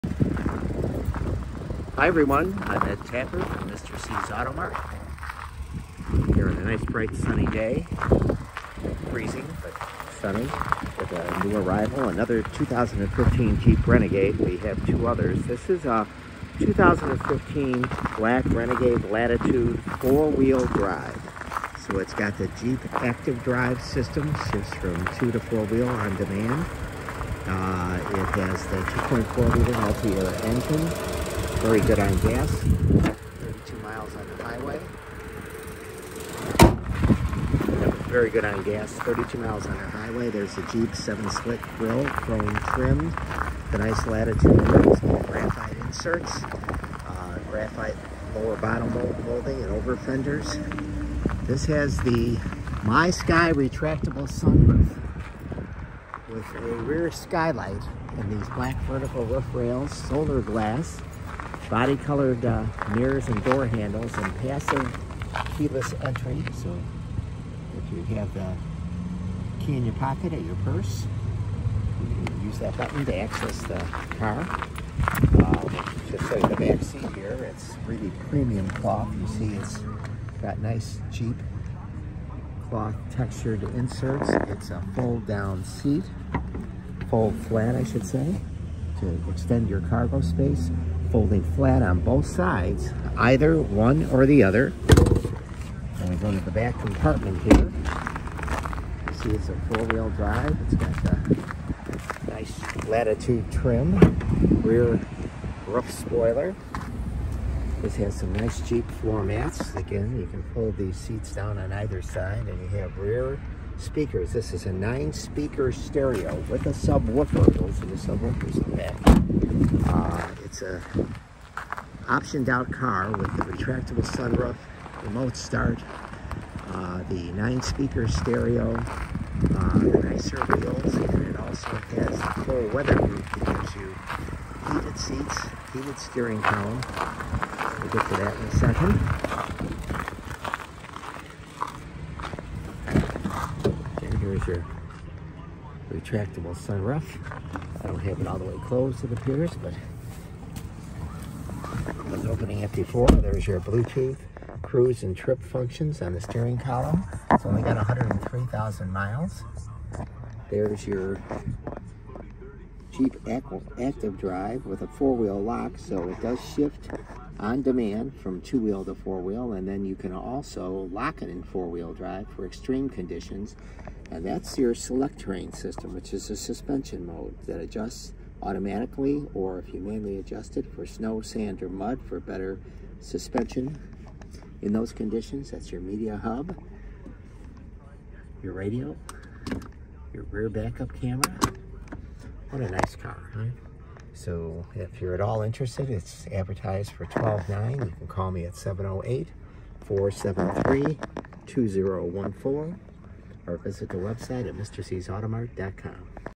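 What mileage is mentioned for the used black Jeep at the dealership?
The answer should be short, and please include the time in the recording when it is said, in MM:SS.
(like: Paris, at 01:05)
103,000 miles, at 02:37.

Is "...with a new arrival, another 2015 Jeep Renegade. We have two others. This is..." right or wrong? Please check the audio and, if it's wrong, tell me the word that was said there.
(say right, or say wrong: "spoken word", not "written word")
right.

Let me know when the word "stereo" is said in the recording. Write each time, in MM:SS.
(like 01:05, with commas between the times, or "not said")
01:55, 02:08.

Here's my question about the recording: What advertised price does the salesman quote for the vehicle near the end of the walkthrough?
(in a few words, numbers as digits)
$12.9.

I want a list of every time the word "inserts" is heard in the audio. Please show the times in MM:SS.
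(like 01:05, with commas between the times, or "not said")
00:45, 01:23.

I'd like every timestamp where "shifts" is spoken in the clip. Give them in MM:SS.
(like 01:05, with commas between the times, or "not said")
00:24, 02:46.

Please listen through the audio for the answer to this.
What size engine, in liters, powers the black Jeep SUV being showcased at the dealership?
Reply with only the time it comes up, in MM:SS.
00:28.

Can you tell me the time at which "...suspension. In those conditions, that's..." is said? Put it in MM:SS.
03:02.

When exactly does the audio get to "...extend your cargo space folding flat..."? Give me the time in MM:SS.
01:29.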